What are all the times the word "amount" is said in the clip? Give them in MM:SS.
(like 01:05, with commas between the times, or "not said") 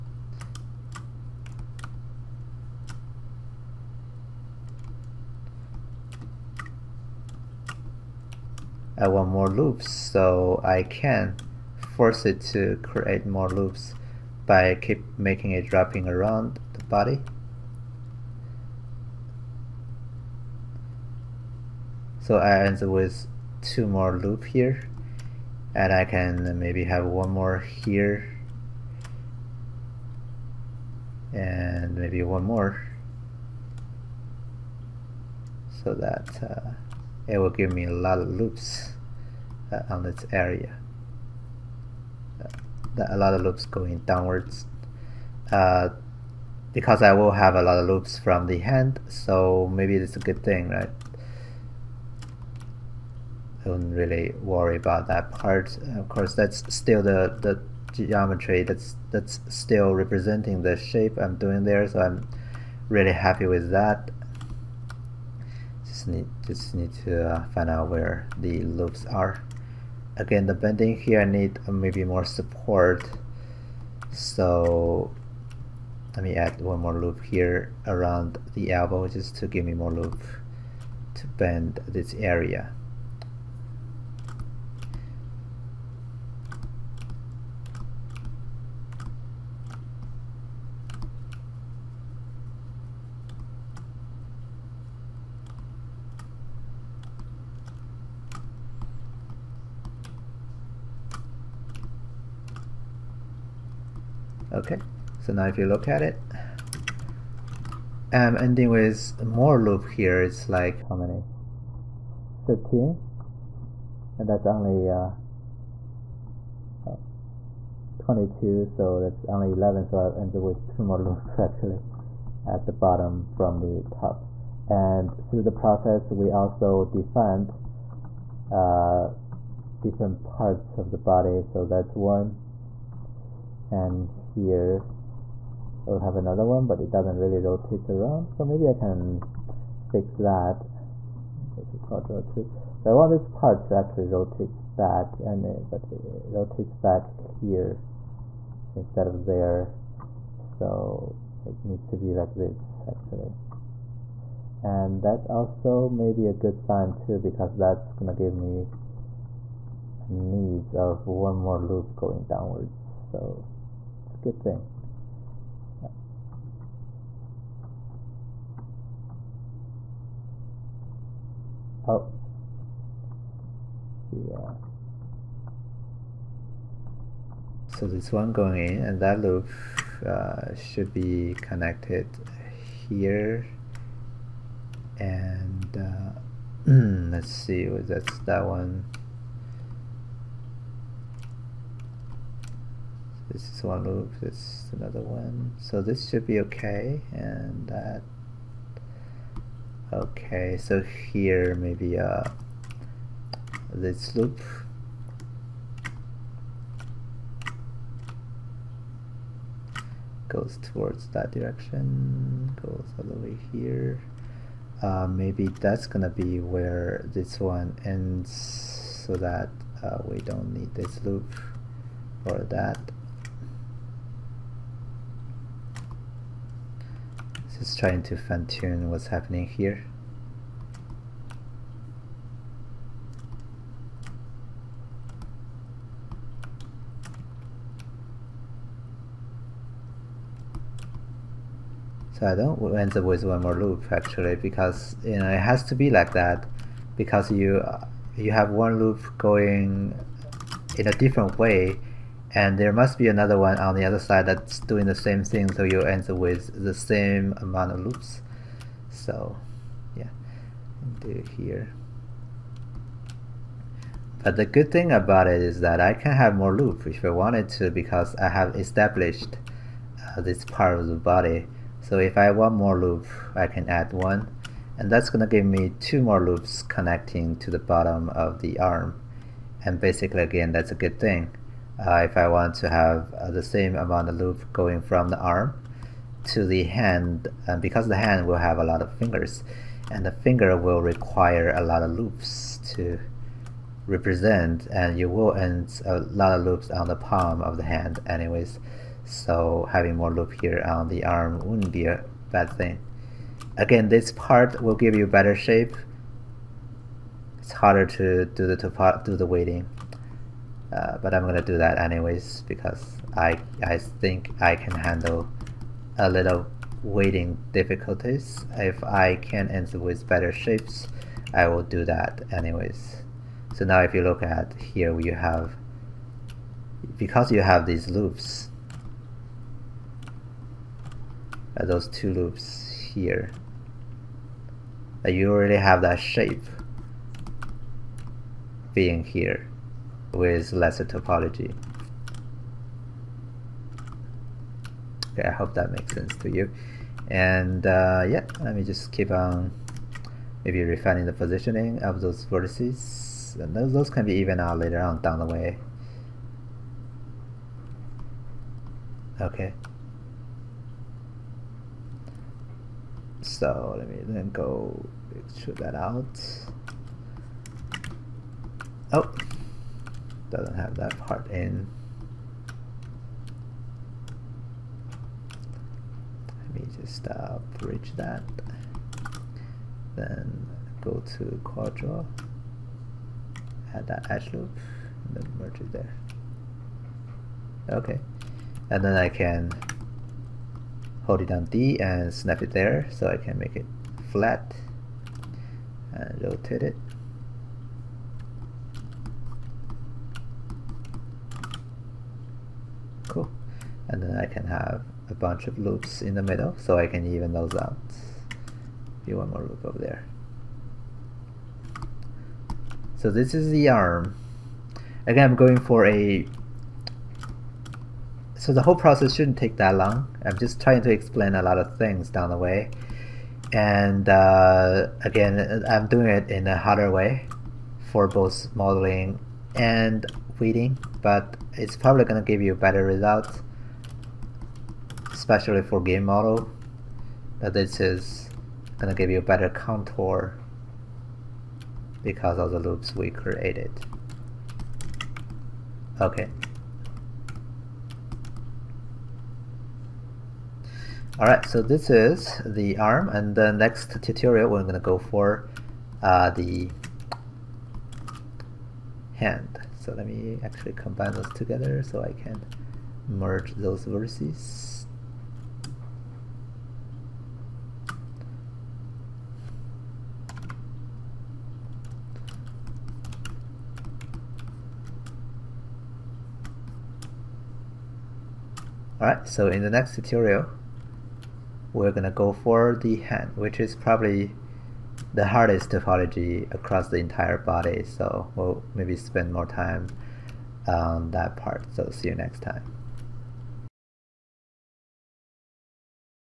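04:17, 04:43.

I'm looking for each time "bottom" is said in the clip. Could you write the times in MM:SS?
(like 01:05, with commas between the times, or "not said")
02:02, 04:37.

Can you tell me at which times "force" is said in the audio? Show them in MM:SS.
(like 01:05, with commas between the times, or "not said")
00:11.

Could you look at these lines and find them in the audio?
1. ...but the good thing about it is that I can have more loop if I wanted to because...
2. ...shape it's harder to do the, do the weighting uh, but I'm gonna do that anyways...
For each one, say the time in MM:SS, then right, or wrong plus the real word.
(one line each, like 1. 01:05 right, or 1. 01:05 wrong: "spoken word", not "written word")
1. 04:24 right
2. 05:05 right.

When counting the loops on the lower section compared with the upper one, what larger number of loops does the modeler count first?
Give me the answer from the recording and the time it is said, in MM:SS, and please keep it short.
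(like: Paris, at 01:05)
13, at 01:52.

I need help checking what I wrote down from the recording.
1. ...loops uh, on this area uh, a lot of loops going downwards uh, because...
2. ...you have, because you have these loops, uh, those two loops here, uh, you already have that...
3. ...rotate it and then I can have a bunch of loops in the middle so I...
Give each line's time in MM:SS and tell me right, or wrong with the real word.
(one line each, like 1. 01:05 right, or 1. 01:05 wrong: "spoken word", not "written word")
1. 00:38 right
2. 05:24 right
3. 06:36 right.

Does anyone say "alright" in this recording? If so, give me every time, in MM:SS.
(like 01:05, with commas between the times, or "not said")
07:31, 07:59.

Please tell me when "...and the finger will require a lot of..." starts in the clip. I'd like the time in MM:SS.
04:49.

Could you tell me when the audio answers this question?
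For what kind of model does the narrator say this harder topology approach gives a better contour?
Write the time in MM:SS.
07:15.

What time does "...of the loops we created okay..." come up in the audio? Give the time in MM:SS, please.
07:22.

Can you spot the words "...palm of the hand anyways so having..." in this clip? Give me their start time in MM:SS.
04:56.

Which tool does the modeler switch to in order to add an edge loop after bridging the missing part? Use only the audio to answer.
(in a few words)
Quad Draw.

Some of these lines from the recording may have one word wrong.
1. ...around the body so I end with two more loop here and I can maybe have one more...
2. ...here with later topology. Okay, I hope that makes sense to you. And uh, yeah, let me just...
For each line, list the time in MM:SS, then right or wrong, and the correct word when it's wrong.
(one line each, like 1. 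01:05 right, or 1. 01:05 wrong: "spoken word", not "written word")
1. 00:16 right
2. 05:39 wrong: "lesser", not "later".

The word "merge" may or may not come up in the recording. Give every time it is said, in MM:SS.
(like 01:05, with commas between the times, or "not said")
06:25, 07:43.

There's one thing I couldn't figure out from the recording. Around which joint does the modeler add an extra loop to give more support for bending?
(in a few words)
elbow.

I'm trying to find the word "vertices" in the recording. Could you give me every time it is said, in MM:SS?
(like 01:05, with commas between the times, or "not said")
05:52, 07:43.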